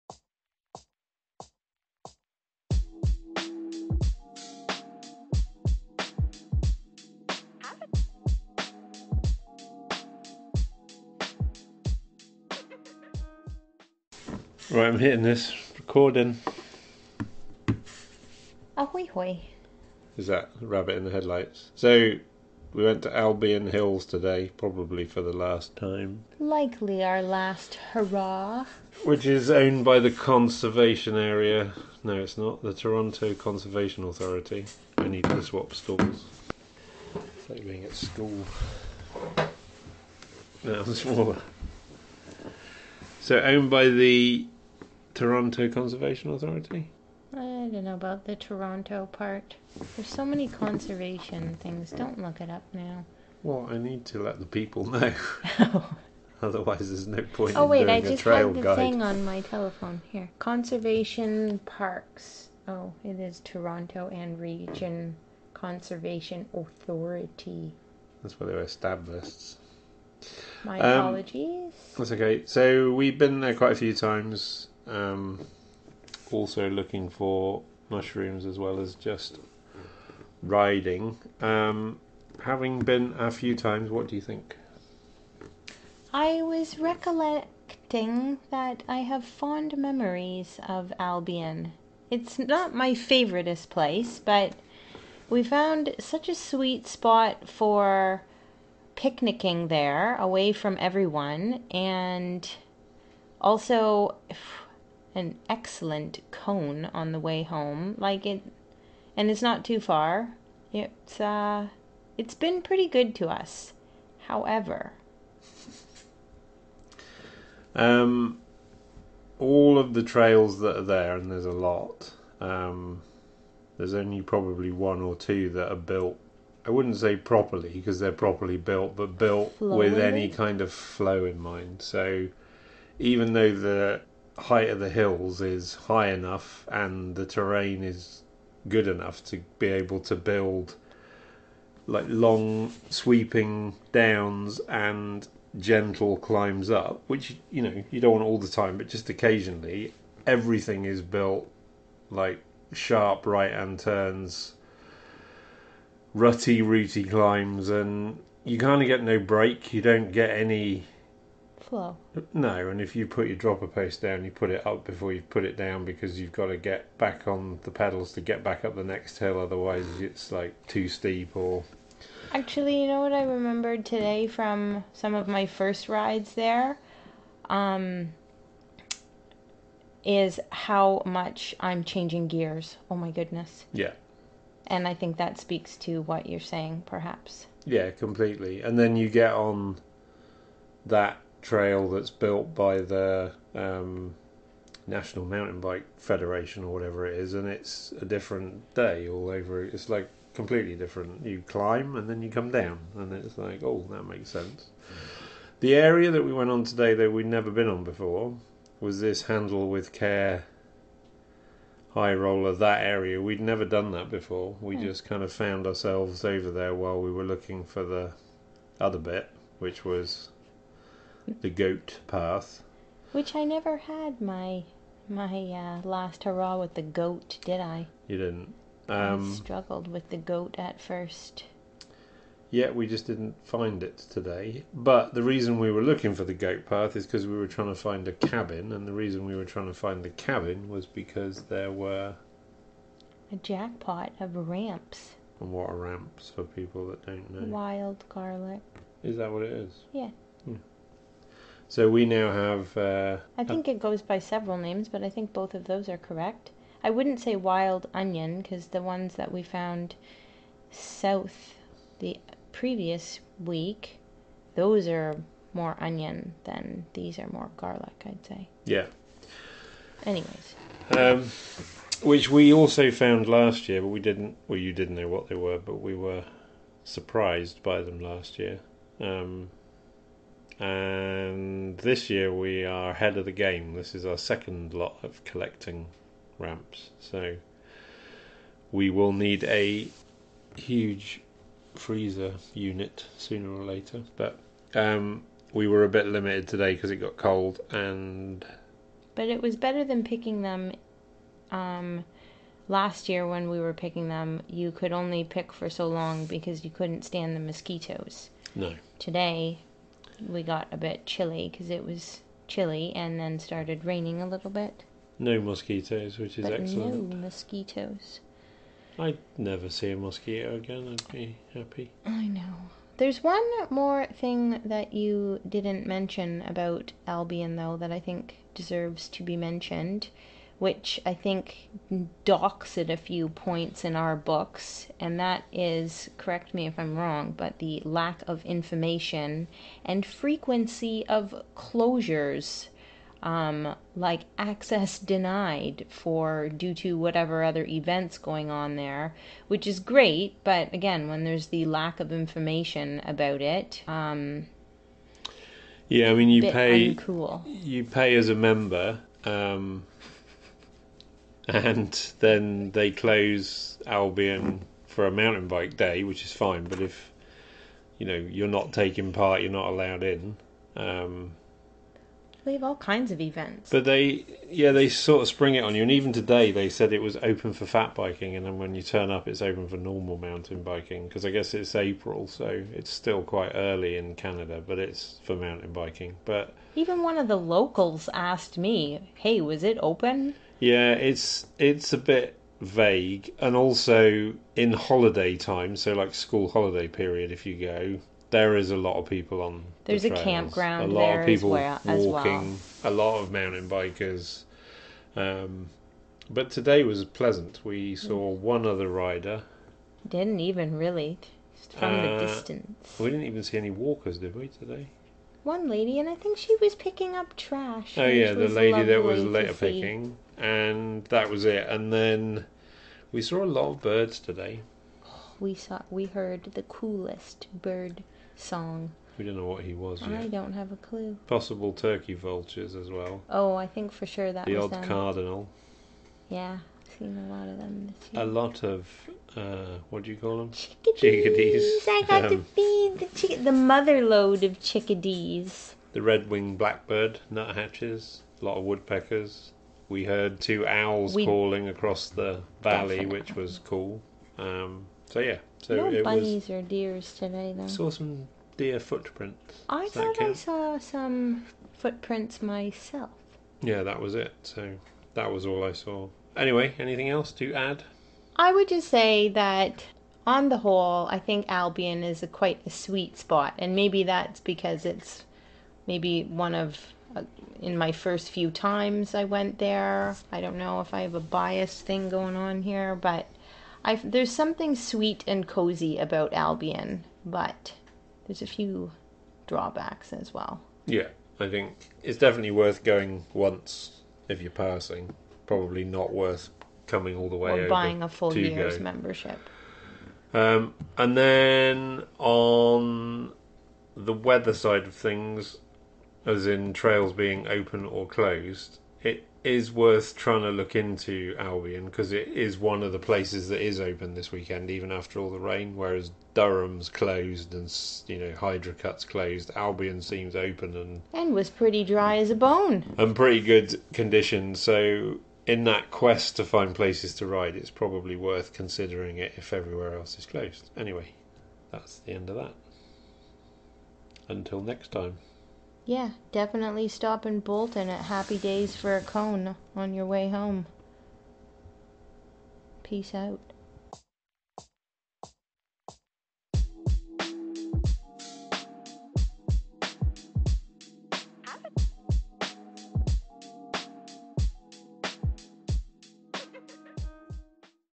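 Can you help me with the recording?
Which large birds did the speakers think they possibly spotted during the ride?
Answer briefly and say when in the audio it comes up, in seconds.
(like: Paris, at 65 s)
Turkey vultures, at 431 s.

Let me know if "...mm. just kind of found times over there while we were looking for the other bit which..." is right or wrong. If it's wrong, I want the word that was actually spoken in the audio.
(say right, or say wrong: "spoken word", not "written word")
wrong: "ourselves", not "times".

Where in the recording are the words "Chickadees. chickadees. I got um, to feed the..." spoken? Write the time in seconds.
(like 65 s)
440 s.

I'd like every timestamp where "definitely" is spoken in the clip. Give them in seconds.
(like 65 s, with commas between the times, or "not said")
452 s, 492 s, 536 s.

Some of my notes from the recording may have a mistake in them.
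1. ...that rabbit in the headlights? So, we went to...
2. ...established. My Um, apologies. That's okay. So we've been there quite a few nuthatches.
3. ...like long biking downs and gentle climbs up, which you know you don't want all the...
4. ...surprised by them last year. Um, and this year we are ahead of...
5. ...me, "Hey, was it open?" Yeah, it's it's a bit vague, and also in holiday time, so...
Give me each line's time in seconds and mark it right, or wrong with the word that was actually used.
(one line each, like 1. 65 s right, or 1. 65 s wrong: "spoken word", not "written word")
1. 20 s right
2. 68 s wrong: "times", not "nuthatches"
3. 141 s wrong: "sweeping", not "biking"
4. 276 s right
5. 388 s right.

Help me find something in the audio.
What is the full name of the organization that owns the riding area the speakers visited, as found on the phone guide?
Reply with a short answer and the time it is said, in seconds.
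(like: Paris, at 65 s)
Toronto and Region Conservation Authority, at 63 s.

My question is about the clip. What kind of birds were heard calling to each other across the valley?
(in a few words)
Owls.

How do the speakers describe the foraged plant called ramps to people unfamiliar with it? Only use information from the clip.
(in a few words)
Wild garlic.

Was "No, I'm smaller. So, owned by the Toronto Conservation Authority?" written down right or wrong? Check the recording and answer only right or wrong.
right.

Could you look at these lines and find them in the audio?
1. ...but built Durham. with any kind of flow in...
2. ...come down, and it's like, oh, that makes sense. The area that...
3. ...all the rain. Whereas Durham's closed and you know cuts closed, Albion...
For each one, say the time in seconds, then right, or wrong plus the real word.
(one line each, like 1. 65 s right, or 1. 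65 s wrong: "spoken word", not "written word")
1. 128 s wrong: "Flowing", not "Durham"
2. 202 s right
3. 515 s right.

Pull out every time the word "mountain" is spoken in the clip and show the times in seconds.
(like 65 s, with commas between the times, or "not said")
195 s, 365 s, 380 s, 385 s, 403 s.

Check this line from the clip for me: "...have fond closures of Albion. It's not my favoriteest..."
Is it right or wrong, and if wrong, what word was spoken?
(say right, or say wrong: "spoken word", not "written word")
wrong: "memories", not "closures".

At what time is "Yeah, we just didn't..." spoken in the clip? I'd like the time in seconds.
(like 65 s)
232 s.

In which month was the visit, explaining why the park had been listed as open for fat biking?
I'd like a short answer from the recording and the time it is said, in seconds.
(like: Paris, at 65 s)
April, at 381 s.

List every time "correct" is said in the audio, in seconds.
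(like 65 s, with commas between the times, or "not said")
255 s, 336 s.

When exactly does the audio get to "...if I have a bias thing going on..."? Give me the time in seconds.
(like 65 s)
480 s.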